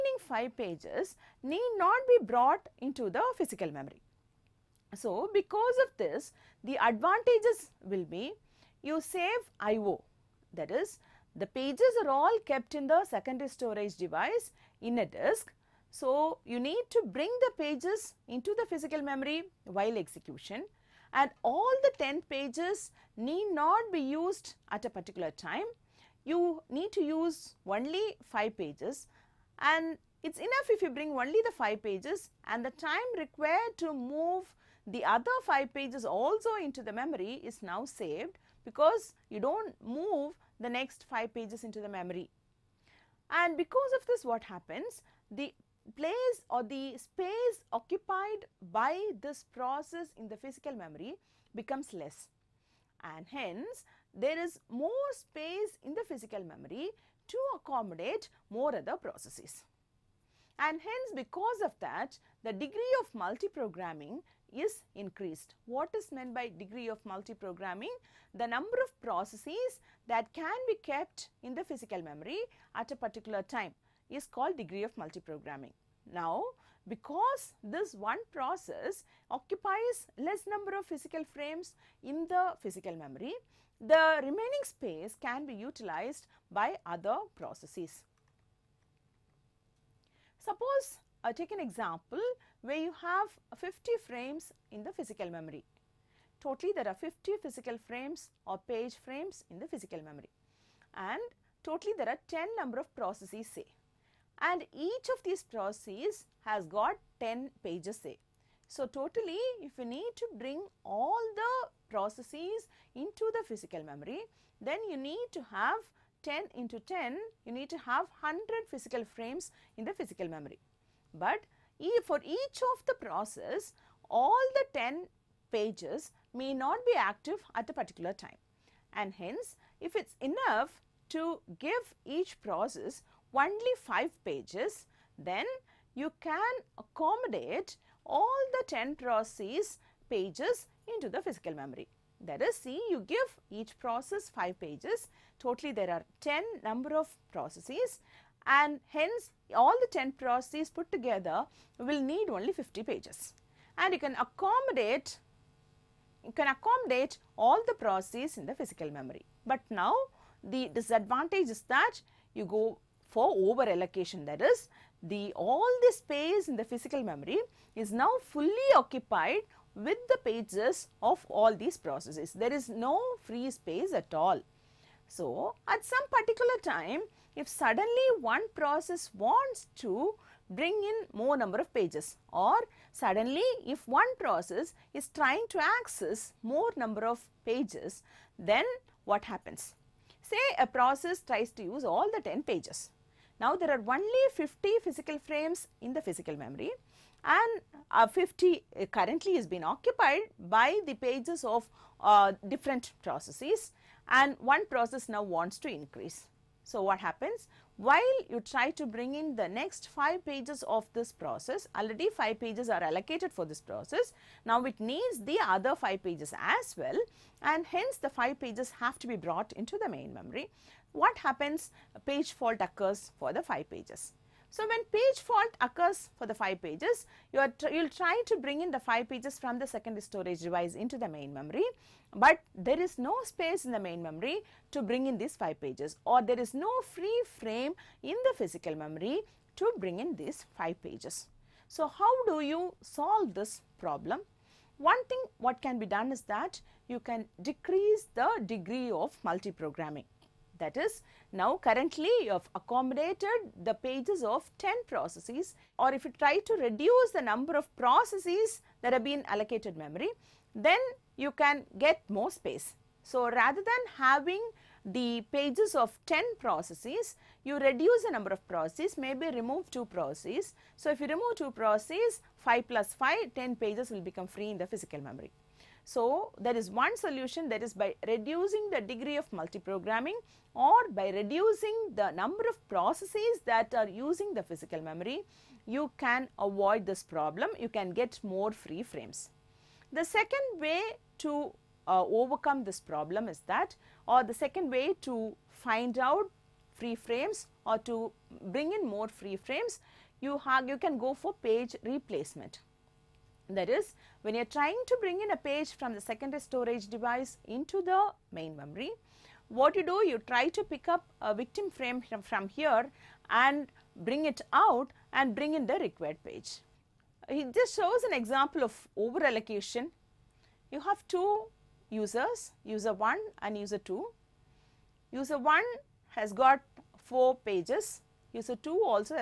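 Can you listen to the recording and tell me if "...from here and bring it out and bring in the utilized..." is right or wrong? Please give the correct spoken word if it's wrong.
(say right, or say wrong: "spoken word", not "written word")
wrong: "required", not "utilized".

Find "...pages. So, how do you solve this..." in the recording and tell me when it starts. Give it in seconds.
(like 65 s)
240 s.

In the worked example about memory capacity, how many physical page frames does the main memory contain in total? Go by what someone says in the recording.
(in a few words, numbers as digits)
50.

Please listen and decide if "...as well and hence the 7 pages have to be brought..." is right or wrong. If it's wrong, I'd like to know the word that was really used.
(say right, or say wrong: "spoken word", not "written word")
wrong: "5", not "7".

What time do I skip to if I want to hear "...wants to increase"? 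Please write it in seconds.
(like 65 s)
205 s.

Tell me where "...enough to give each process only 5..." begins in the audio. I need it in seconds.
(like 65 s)
130 s.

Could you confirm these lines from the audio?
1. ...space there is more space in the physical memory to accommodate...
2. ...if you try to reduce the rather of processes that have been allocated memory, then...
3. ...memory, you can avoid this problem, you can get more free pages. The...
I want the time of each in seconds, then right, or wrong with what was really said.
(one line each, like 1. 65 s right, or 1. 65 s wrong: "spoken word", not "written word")
1. 53 s wrong: "hence", not "space"
2. 255 s wrong: "number", not "rather"
3. 284 s wrong: "frames", not "pages".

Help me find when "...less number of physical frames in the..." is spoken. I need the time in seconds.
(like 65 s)
80 s.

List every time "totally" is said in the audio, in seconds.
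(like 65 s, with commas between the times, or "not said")
96 s, 101 s, 108 s, 145 s.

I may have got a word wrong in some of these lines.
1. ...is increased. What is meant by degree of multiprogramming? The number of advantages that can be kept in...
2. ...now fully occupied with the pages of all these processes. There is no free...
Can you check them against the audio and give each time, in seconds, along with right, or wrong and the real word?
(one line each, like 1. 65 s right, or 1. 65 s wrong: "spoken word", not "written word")
1. 64 s wrong: "processes", not "advantages"
2. 168 s right.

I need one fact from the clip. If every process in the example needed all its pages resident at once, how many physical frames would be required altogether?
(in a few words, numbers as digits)
100.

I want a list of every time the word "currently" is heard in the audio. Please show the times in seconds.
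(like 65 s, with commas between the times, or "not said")
198 s, 251 s.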